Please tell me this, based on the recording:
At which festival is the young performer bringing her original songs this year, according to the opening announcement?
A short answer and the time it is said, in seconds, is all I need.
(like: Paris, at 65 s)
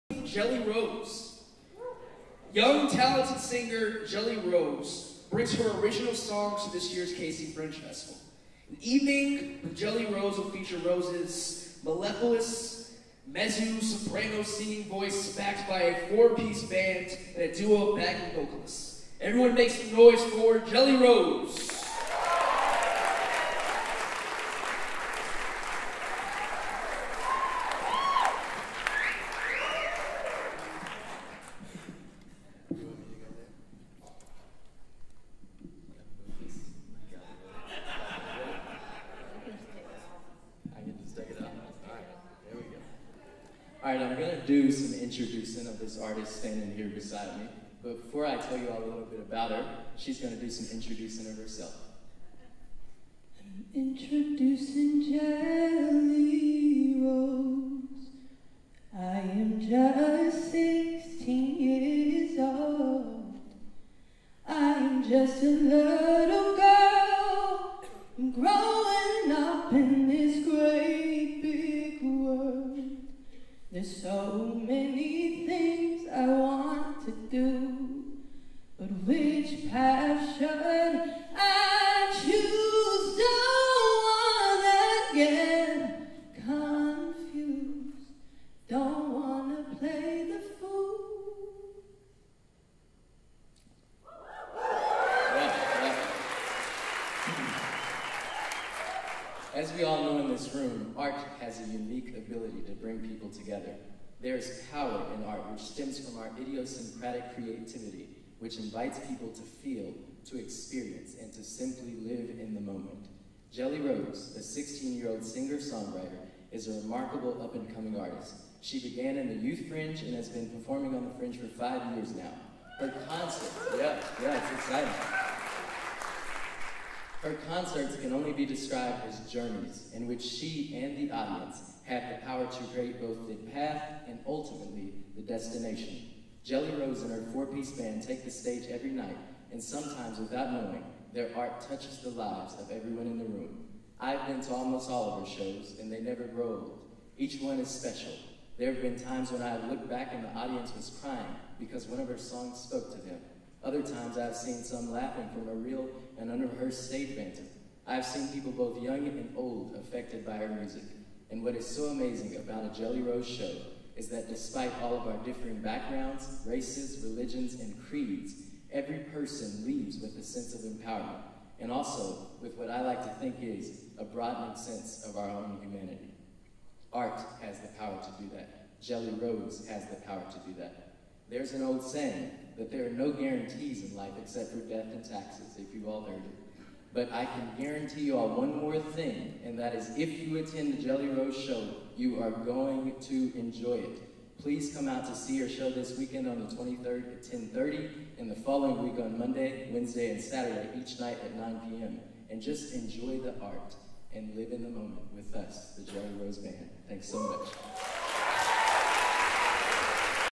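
KC Fringe Festival, at 7 s.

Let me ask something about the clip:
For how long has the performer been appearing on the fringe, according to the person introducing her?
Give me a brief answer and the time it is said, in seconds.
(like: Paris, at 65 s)
5 years, at 121 s.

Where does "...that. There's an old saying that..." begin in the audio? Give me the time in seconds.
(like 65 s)
180 s.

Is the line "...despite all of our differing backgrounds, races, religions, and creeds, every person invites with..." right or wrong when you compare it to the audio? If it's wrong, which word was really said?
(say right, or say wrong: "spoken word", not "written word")
wrong: "leaves", not "invites".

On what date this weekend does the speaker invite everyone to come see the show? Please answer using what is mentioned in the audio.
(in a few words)
the 23rd.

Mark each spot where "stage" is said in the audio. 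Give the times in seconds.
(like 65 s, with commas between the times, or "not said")
138 s, 156 s.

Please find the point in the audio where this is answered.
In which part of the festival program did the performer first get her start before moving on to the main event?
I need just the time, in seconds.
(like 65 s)
119 s.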